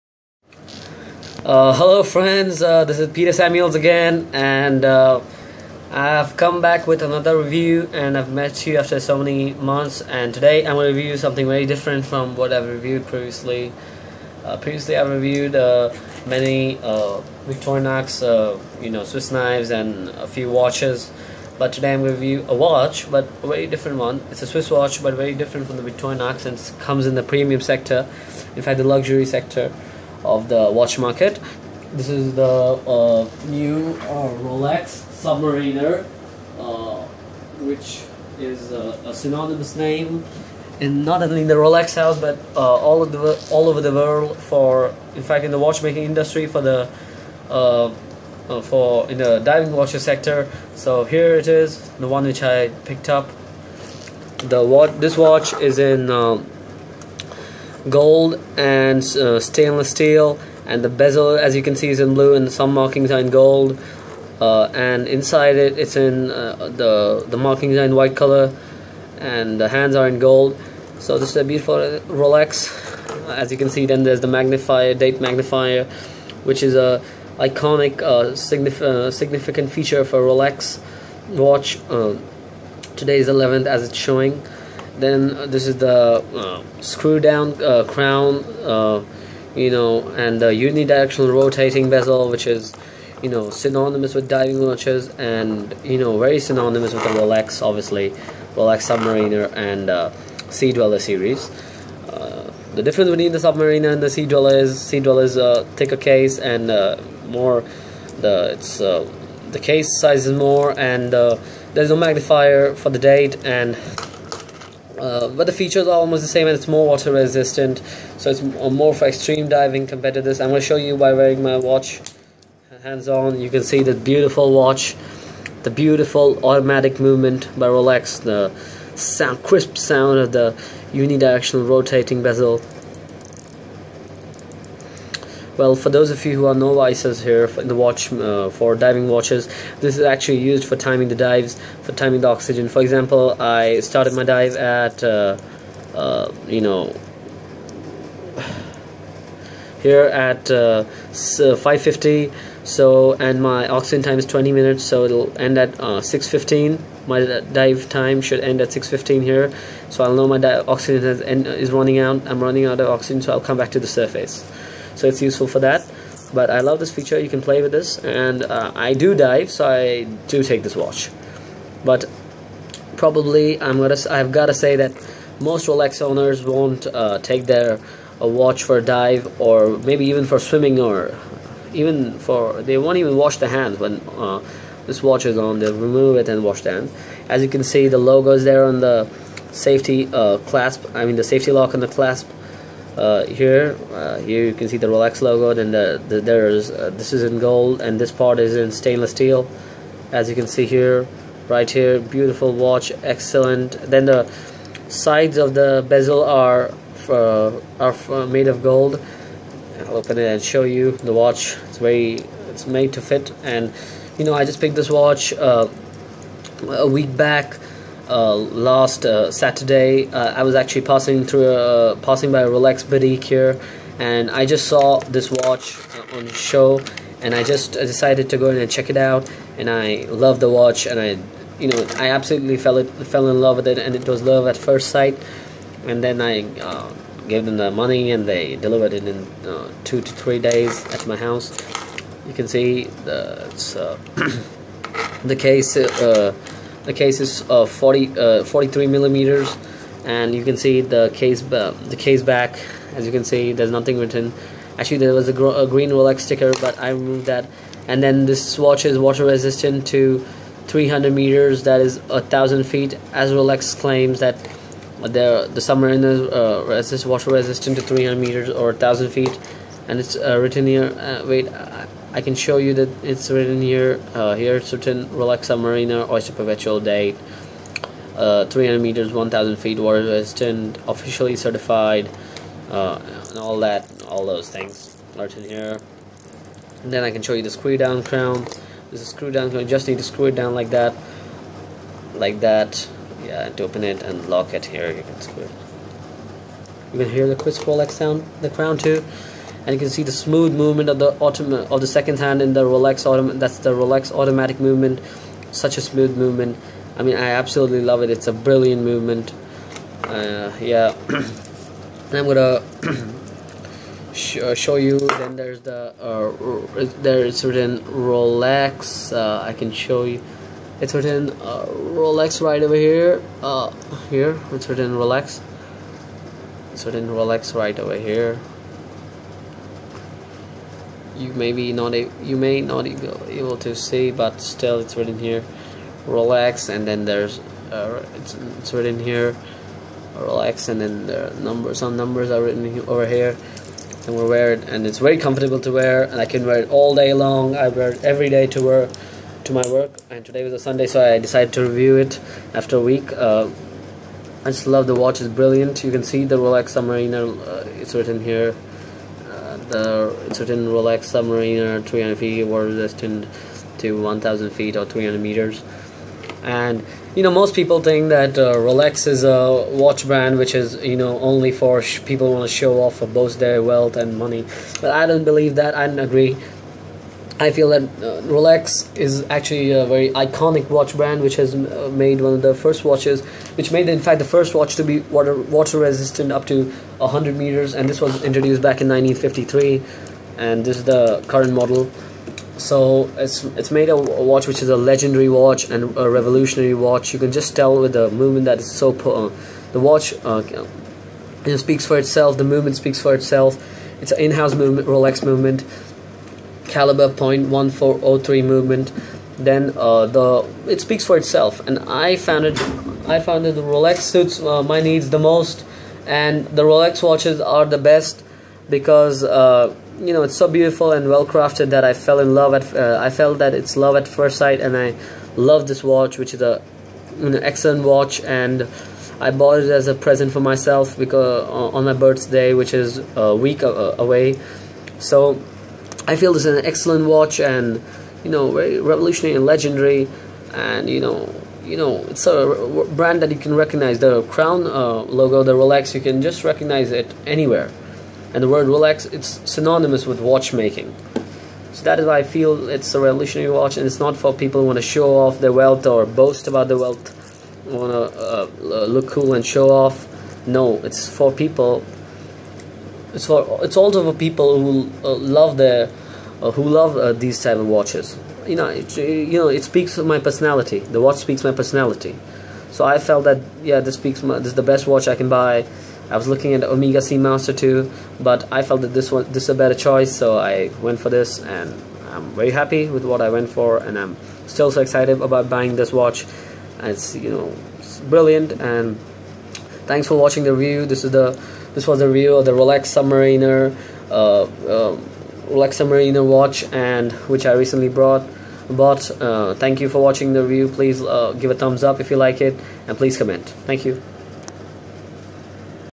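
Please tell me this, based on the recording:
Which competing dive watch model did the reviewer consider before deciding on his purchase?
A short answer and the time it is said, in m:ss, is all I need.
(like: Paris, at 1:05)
Omega Seamaster, at 7:56.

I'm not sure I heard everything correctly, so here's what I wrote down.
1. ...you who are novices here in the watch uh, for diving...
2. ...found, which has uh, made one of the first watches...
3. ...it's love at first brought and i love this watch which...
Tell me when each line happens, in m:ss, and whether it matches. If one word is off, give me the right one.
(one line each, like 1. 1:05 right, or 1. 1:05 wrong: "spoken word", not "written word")
1. 2:16 right
2. 6:20 wrong: "brand", not "found"
3. 7:03 wrong: "sight", not "brought".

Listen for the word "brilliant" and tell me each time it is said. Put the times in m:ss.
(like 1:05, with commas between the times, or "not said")
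5:08, 5:55, 8:08.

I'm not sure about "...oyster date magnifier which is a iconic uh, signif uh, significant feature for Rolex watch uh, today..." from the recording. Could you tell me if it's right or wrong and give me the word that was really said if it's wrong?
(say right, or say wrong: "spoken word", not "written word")
wrong: "magnifier", not "oyster".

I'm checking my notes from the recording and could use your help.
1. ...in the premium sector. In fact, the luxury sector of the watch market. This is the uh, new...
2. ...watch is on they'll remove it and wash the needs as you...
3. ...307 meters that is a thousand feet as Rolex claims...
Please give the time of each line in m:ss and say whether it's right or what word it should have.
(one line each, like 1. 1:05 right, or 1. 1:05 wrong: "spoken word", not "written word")
1. 0:27 right
2. 3:05 wrong: "hands", not "needs"
3. 4:20 wrong: "300", not "307".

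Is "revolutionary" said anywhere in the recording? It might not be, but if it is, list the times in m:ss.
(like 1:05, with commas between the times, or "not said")
6:36, 7:18, 7:32.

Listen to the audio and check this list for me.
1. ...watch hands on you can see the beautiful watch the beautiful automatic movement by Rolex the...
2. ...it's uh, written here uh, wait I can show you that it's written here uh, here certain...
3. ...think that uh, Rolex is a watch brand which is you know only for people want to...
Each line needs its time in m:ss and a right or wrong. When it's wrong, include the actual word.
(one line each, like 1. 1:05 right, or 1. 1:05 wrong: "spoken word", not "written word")
1. 2:01 right
2. 4:29 right
3. 6:07 right.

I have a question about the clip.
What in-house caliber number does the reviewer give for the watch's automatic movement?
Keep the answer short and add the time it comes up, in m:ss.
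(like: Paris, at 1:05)
0.1403, at 6:46.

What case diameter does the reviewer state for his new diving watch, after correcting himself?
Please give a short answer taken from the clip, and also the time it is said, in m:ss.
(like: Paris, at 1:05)
43 millimeters, at 4:08.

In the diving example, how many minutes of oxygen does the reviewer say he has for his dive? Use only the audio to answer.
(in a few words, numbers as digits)
20 minutes.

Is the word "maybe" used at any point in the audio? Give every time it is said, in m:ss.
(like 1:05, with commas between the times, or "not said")
2:59, 5:31.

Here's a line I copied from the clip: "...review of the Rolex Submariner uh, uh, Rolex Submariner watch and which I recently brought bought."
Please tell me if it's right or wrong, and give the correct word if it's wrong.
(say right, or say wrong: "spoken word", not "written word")
right.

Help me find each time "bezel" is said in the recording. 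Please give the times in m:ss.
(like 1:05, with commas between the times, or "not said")
1:00, 1:31, 2:12, 3:25.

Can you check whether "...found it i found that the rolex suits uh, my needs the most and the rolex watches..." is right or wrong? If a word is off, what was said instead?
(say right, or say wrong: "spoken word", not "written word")
right.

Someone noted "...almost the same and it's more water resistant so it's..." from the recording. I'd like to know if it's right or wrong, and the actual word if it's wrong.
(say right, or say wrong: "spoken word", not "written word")
right.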